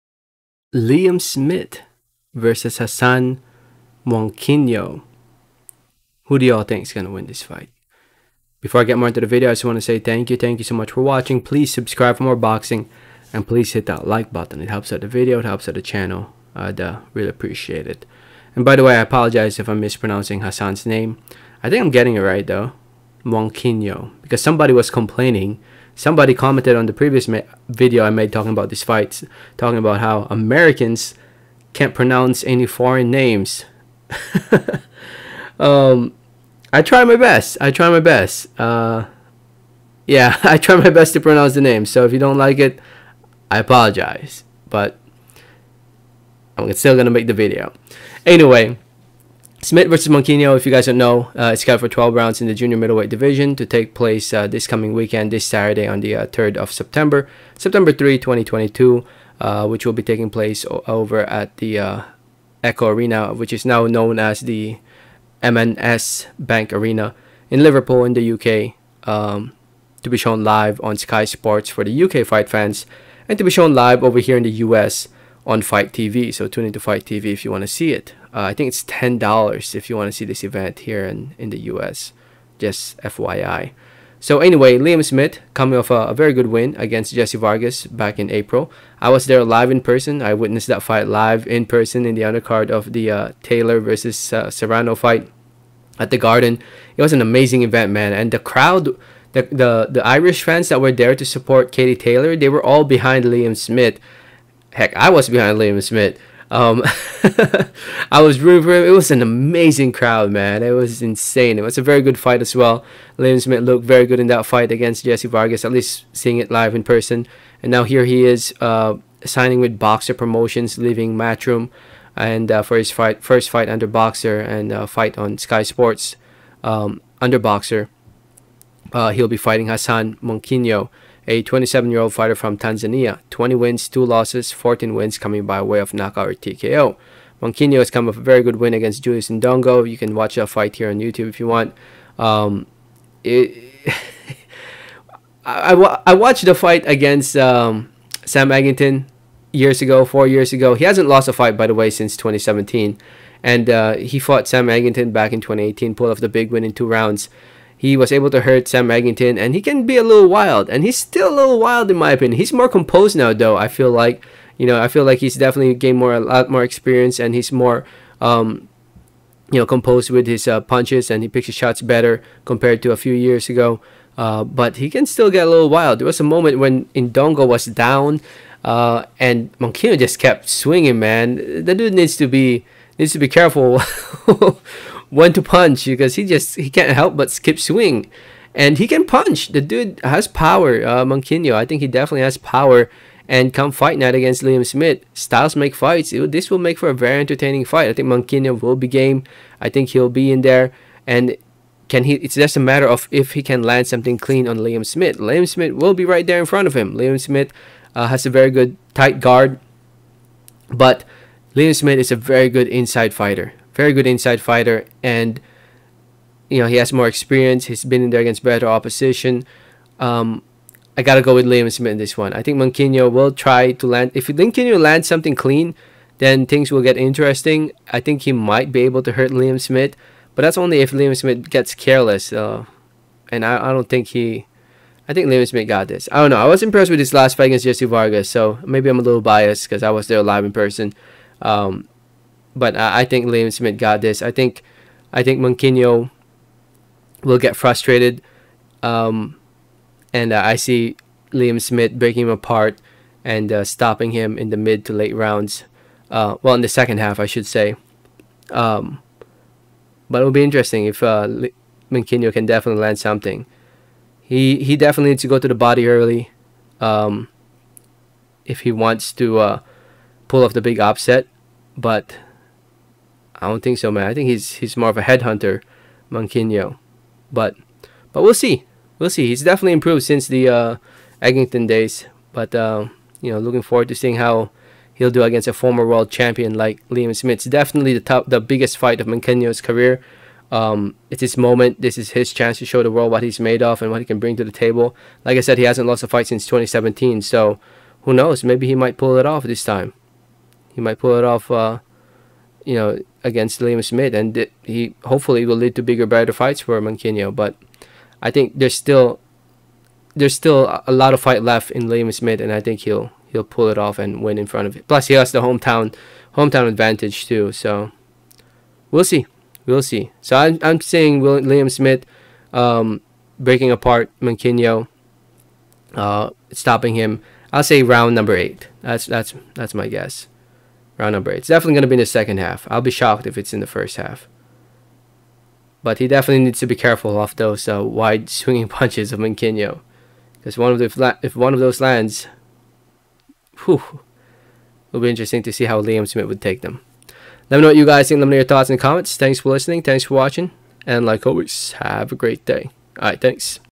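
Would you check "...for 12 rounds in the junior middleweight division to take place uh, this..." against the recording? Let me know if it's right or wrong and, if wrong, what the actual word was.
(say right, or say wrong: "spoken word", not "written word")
right.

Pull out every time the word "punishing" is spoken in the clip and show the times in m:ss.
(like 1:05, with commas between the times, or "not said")
not said.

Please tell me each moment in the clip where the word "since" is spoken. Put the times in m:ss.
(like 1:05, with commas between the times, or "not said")
2:31, 4:40, 4:56.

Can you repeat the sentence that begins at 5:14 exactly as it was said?
Plus, he has the hometown hometown advantage too.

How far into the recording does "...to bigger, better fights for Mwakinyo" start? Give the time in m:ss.
5:05.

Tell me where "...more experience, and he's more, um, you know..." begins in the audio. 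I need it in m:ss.
2:46.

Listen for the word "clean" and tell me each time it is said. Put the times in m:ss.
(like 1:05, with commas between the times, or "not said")
3:24, 3:45.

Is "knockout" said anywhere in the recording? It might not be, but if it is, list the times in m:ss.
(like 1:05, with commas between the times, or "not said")
2:15.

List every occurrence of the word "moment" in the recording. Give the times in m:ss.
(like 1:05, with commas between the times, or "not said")
2:56, 4:51.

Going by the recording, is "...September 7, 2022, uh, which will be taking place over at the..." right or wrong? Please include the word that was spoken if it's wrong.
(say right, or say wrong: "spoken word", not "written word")
wrong: "3", not "7".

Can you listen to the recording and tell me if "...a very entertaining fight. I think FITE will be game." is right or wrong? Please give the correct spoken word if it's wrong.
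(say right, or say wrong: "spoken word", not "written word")
wrong: "Mwakinyo", not "FITE".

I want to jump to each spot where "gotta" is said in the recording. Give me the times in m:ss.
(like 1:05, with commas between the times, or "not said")
3:41.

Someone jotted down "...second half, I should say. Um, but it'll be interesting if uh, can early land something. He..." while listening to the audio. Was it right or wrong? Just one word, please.
wrong.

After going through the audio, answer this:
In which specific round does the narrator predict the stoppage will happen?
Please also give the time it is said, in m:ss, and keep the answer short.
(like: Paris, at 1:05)
8, at 5:27.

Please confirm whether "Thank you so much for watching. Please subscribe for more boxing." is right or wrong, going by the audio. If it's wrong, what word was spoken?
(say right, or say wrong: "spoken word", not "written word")
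right.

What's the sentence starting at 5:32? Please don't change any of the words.
I'll be shocked if it's in the first half.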